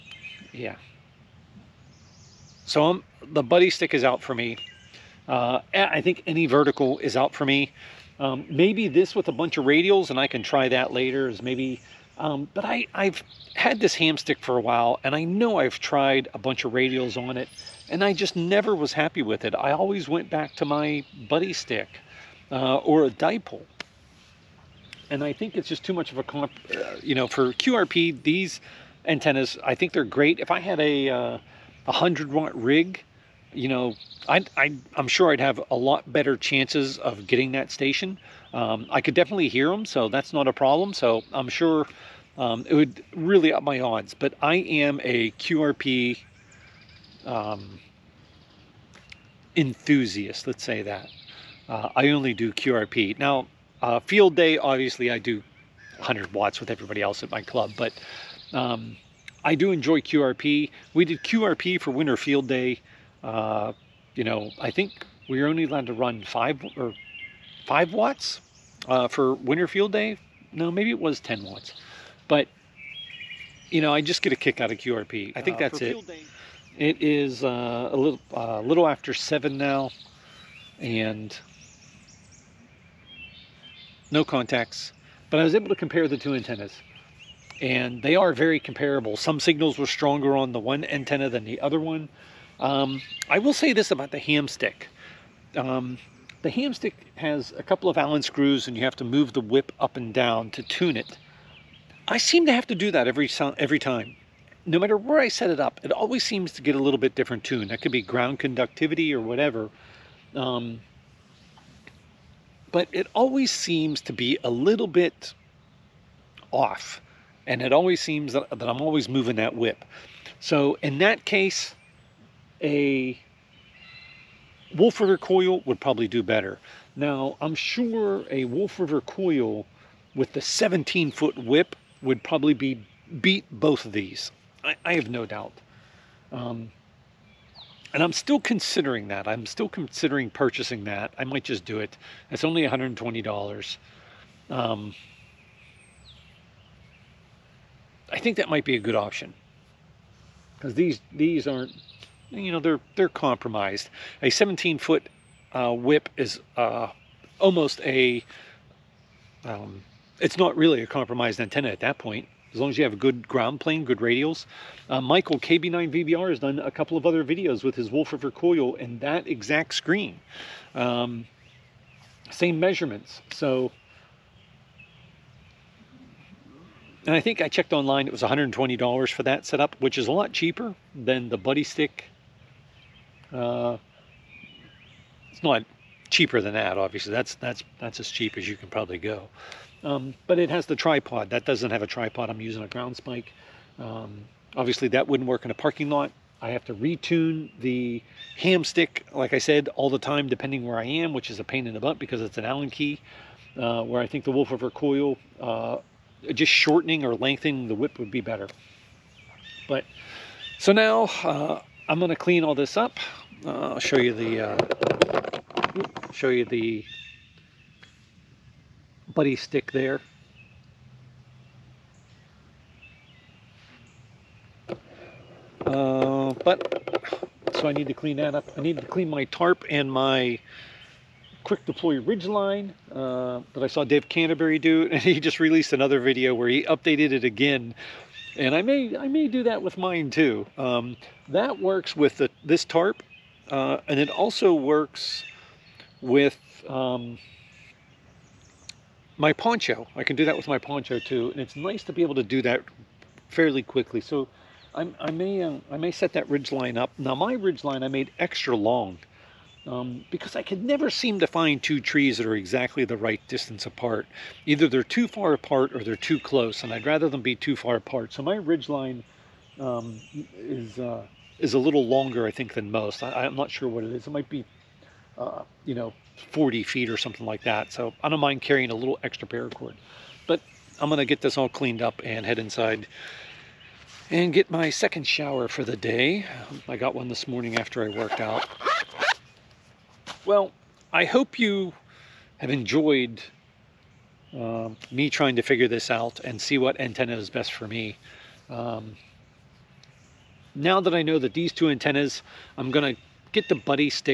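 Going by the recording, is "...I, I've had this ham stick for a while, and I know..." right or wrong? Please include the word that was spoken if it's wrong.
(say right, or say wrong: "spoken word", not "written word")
right.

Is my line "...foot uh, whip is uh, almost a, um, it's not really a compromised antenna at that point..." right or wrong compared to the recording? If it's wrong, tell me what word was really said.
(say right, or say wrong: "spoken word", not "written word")
right.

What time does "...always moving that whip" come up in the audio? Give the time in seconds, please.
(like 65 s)
118 s.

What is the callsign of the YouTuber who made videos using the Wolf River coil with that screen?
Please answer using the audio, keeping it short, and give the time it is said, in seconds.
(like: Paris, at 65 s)
KB9VBR, at 165 s.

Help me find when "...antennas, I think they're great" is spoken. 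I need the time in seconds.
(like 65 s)
29 s.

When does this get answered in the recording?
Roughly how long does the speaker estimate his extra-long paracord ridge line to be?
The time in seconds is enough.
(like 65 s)
276 s.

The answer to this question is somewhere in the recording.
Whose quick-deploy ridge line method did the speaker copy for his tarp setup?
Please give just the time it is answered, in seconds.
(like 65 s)
233 s.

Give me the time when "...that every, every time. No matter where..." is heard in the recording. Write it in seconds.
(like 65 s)
102 s.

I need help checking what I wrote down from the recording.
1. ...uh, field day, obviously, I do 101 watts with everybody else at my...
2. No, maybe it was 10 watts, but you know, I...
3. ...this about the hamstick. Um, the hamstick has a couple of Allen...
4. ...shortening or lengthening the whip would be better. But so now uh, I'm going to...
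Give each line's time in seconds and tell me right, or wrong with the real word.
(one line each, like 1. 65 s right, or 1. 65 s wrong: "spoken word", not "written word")
1. 53 s wrong: "100", not "101"
2. 70 s right
3. 93 s right
4. 206 s right.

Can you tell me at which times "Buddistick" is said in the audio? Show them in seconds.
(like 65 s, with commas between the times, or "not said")
3 s, 21 s, 181 s, 219 s, 303 s.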